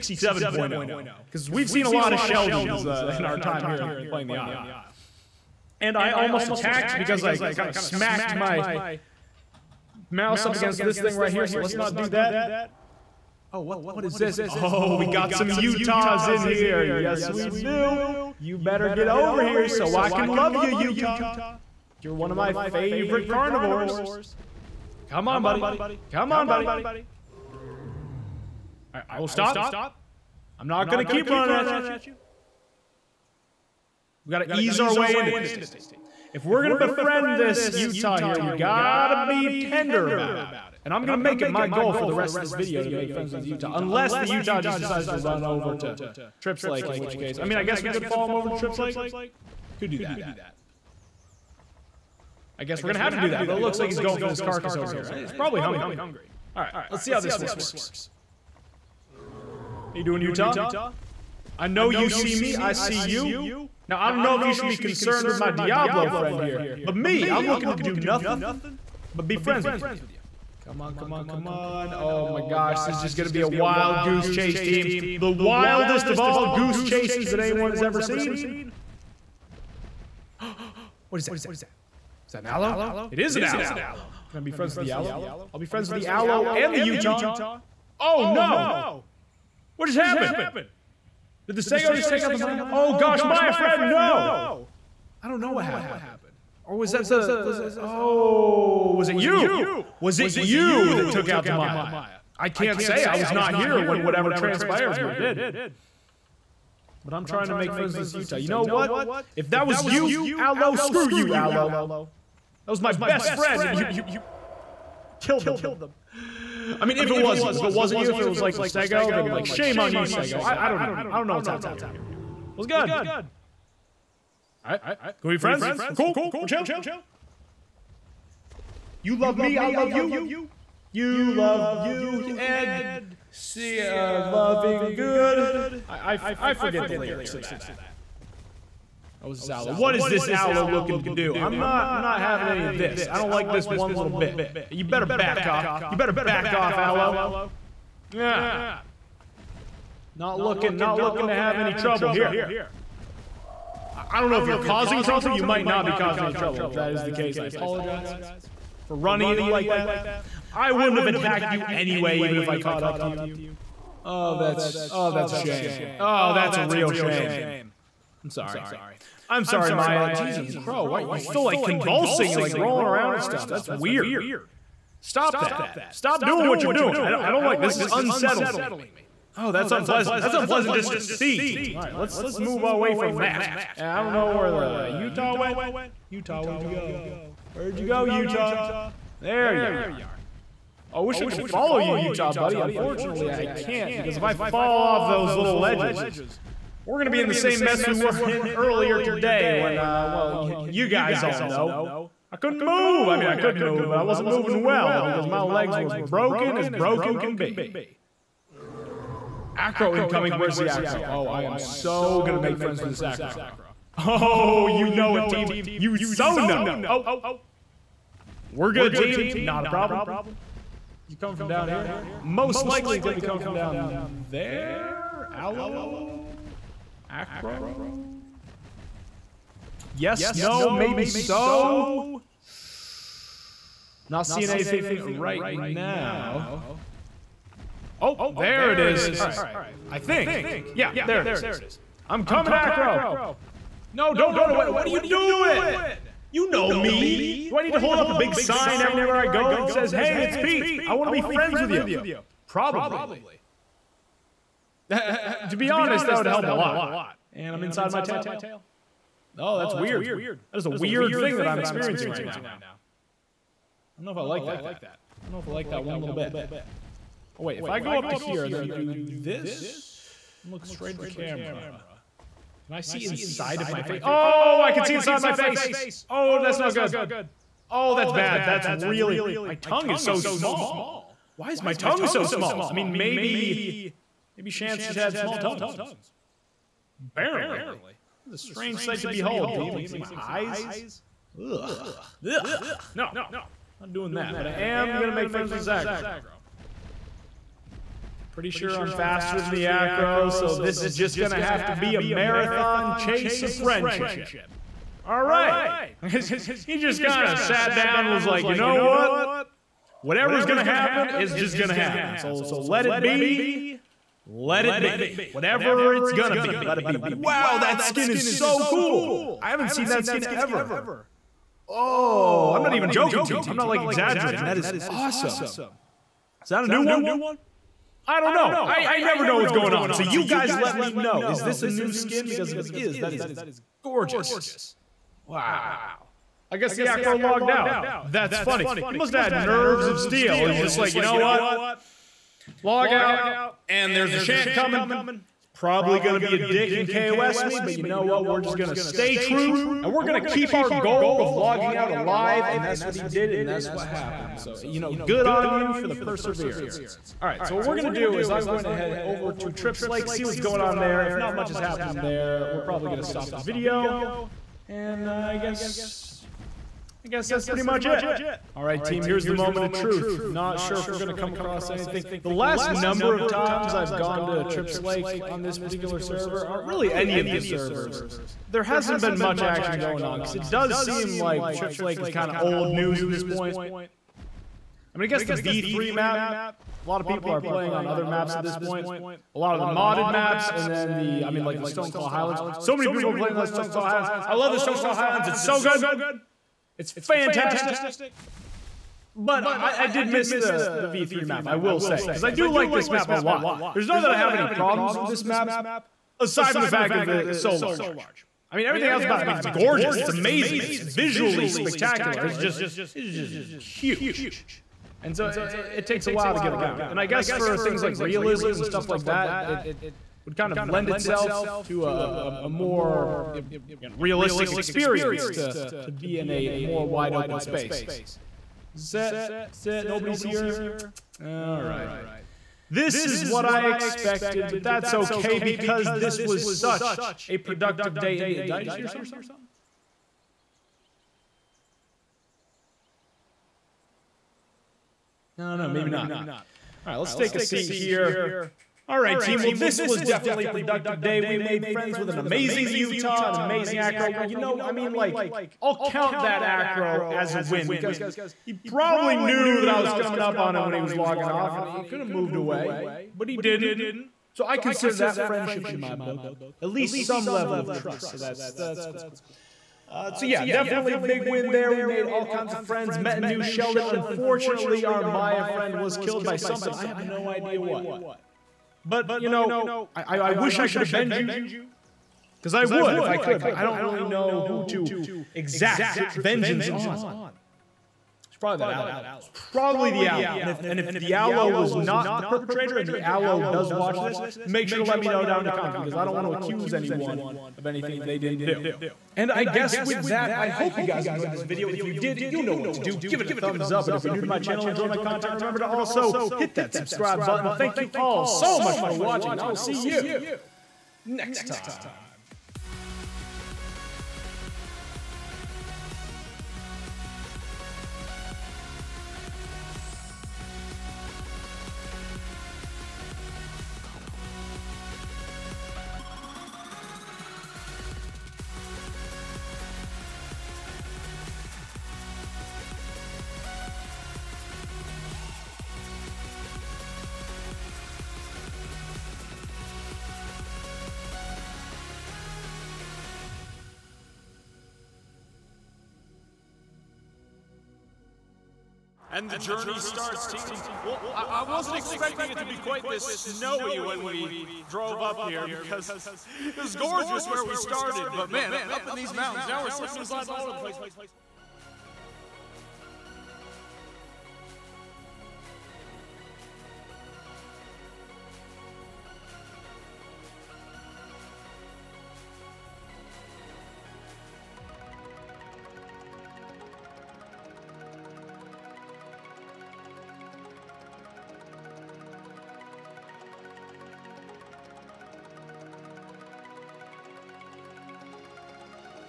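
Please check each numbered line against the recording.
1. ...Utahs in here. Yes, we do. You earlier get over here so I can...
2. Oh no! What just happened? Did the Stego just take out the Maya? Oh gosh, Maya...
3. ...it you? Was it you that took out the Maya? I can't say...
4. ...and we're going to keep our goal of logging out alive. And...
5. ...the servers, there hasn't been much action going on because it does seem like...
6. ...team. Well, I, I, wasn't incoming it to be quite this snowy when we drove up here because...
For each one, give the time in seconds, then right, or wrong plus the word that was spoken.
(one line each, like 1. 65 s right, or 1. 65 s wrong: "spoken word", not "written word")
1. 15 s wrong: "better", not "earlier"
2. 87 s right
3. 99 s right
4. 349 s right
5. 377 s right
6. 550 s wrong: "expecting", not "incoming".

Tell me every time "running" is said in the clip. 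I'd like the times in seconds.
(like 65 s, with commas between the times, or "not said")
31 s, 158 s.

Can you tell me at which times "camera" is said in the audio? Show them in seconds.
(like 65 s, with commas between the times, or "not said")
271 s.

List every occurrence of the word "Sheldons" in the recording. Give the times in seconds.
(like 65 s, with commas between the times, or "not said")
2 s, 473 s.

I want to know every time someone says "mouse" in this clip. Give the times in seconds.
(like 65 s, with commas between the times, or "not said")
10 s.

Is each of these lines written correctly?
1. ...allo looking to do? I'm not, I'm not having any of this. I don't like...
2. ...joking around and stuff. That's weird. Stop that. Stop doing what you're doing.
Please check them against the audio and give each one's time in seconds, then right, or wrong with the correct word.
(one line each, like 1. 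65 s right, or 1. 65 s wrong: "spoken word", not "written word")
1. 140 s right
2. 172 s wrong: "rolling", not "joking".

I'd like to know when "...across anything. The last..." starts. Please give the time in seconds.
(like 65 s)
371 s.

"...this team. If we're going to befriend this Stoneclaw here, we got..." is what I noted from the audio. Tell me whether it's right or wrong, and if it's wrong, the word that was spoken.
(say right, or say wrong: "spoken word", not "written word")
wrong: "Utah", not "Stoneclaw".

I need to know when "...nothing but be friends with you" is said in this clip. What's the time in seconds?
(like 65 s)
67 s.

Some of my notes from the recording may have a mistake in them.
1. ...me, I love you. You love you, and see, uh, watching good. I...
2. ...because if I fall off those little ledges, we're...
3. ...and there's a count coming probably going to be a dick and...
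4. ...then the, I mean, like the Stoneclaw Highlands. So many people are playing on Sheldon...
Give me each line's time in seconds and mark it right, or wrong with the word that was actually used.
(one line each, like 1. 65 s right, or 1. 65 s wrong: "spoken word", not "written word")
1. 129 s wrong: "loving", not "watching"
2. 193 s right
3. 343 s wrong: "shant", not "count"
4. 390 s wrong: "Stoneclaw", not "Sheldon".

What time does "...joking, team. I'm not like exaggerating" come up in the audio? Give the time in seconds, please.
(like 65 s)
322 s.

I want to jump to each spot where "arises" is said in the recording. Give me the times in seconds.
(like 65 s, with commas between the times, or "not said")
not said.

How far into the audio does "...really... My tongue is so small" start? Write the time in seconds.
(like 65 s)
278 s.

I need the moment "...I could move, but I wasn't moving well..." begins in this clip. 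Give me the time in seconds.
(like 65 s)
203 s.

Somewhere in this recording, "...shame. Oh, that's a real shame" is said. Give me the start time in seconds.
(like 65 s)
165 s.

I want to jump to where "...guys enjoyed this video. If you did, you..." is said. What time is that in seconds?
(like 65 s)
500 s.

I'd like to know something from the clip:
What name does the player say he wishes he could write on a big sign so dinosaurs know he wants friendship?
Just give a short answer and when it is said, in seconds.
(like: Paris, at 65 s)
Pete, at 250 s.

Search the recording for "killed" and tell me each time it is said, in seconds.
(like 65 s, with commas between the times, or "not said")
115 s, 475 s.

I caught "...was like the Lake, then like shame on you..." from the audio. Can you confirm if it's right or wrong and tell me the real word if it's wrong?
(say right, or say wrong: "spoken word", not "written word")
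wrong: "Stego", not "Lake".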